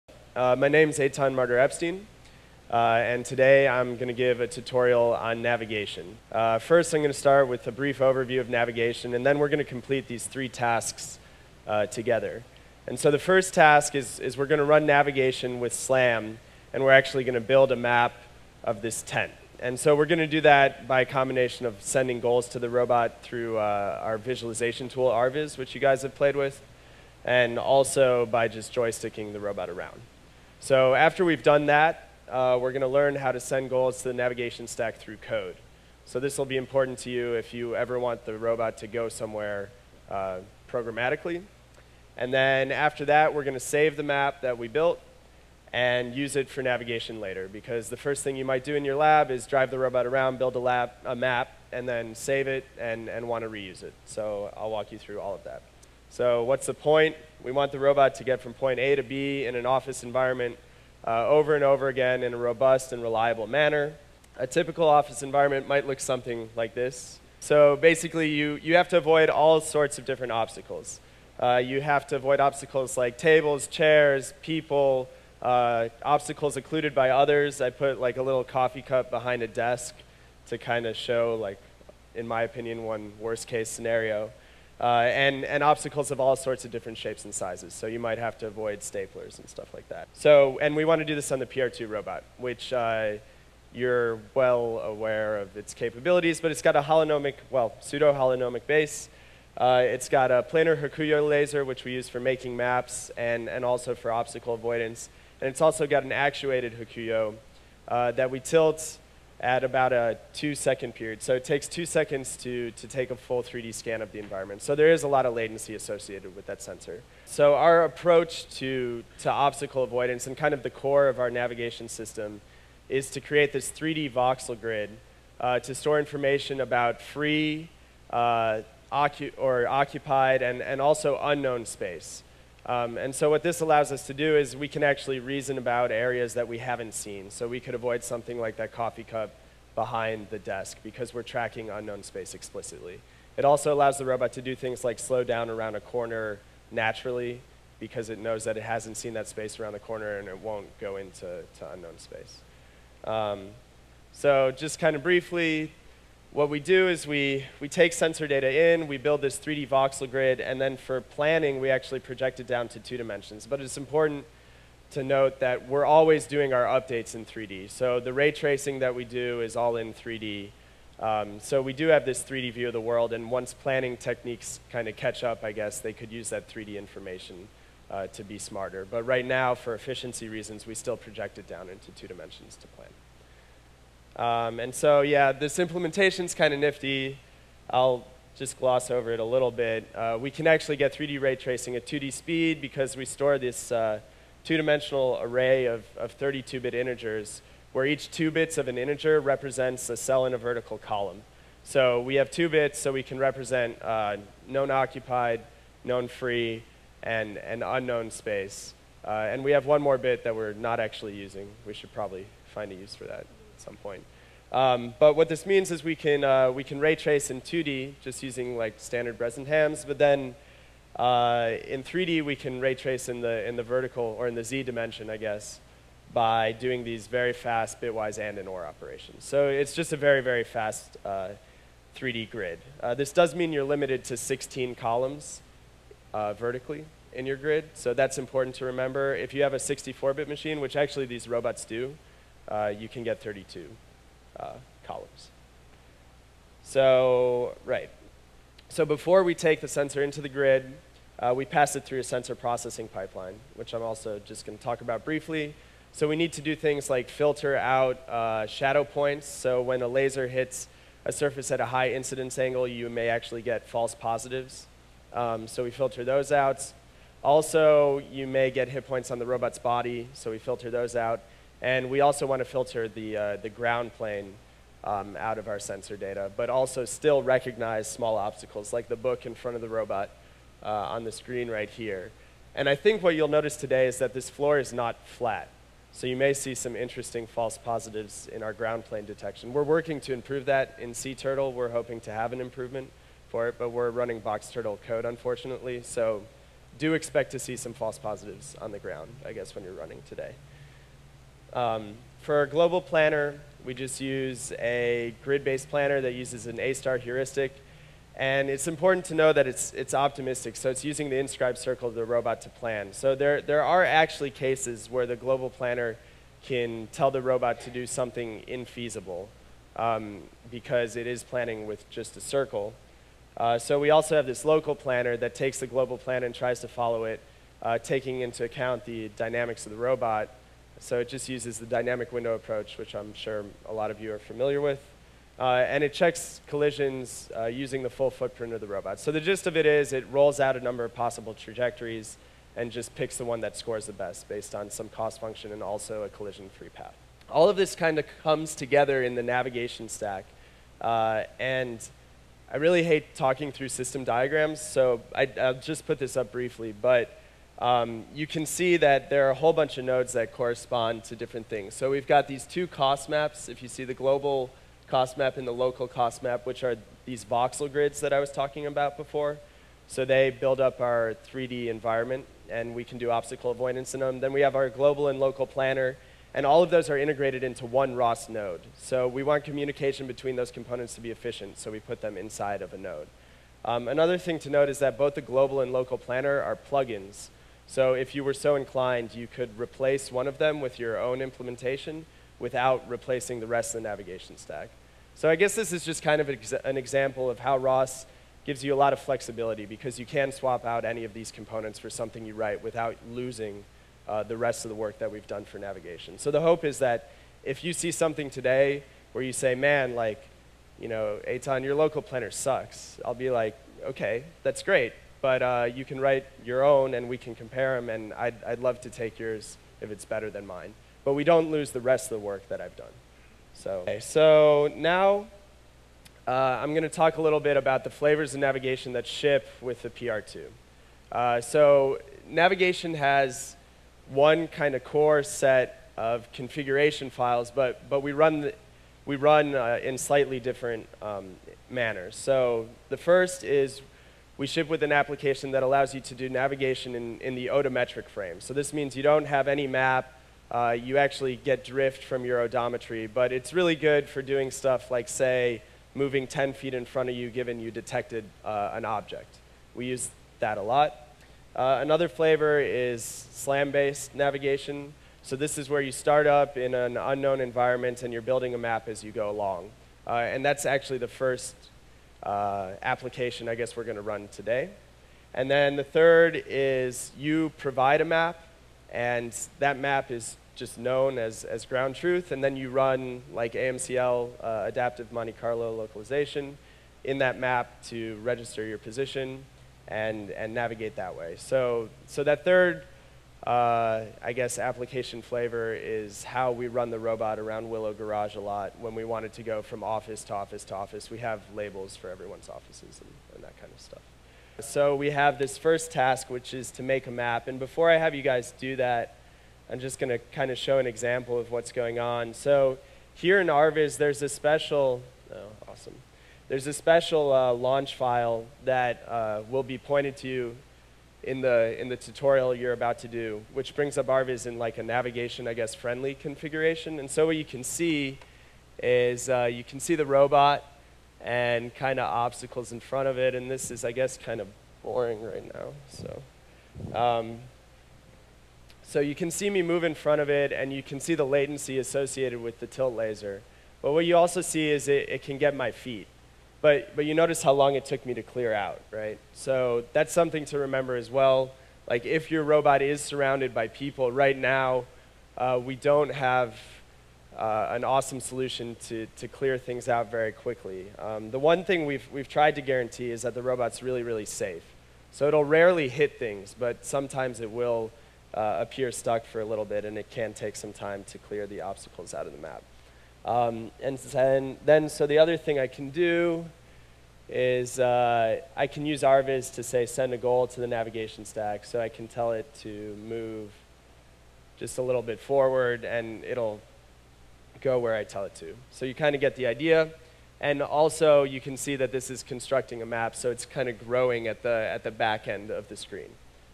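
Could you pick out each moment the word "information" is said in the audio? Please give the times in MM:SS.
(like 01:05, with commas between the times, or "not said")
02:05, 02:56.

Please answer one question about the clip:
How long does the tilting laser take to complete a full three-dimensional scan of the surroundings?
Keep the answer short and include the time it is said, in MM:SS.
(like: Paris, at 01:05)
2 seconds, at 01:51.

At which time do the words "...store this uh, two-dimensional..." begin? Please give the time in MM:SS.
03:13.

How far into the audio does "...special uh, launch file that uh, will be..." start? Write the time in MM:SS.
08:36.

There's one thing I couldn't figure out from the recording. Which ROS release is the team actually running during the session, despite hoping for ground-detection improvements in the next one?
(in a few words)
Box Turtle.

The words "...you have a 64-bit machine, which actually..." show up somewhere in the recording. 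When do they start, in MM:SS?
03:59.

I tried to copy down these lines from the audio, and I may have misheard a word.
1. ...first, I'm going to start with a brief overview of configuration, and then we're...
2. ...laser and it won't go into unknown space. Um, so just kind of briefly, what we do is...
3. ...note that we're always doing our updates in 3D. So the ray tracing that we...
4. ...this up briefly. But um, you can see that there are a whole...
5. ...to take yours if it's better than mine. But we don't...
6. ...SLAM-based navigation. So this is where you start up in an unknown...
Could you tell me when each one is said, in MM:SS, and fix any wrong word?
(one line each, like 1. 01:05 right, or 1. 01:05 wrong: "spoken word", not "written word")
1. 00:06 wrong: "navigation", not "configuration"
2. 02:29 wrong: "corner", not "laser"
3. 02:45 right
4. 05:55 right
5. 06:58 right
6. 07:43 right.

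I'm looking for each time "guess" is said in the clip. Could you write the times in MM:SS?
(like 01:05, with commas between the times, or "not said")
02:55, 03:45, 04:59, 06:35, 07:53, 08:14, 08:45, 08:53.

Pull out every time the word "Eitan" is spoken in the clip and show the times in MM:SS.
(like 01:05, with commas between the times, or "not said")
00:00, 06:51.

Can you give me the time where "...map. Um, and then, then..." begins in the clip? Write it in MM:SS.
09:32.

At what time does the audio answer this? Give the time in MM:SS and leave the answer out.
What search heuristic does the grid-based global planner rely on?
05:06.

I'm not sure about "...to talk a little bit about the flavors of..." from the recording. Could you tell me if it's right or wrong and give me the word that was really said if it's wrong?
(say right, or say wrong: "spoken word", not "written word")
right.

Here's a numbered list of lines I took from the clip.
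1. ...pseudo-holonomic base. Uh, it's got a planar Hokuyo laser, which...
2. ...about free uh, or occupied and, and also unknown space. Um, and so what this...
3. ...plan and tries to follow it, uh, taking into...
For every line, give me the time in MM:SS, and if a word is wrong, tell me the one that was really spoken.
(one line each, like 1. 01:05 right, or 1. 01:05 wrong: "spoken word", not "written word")
1. 01:37 right
2. 02:06 right
3. 05:25 right.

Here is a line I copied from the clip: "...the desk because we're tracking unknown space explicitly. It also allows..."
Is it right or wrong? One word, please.
right.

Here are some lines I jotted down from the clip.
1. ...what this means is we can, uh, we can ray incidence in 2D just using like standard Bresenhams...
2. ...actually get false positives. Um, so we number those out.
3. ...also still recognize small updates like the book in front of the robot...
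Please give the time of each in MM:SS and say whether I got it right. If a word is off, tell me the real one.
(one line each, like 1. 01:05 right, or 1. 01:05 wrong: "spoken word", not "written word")
1. 03:35 wrong: "trace", not "incidence"
2. 04:23 wrong: "filter", not "number"
3. 04:36 wrong: "obstacles", not "updates".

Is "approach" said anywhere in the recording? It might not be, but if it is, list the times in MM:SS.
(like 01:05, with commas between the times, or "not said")
01:57, 05:32.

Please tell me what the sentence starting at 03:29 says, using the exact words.
Uh, and we have one more bit that we're not actually using.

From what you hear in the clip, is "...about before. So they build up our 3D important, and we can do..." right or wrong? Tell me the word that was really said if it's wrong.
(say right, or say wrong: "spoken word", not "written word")
wrong: "environment", not "important".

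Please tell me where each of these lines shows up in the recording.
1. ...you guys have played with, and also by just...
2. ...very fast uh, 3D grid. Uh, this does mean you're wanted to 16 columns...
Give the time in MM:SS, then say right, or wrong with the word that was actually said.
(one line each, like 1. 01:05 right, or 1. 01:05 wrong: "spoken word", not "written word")
1. 00:25 right
2. 03:50 wrong: "limited", not "wanted".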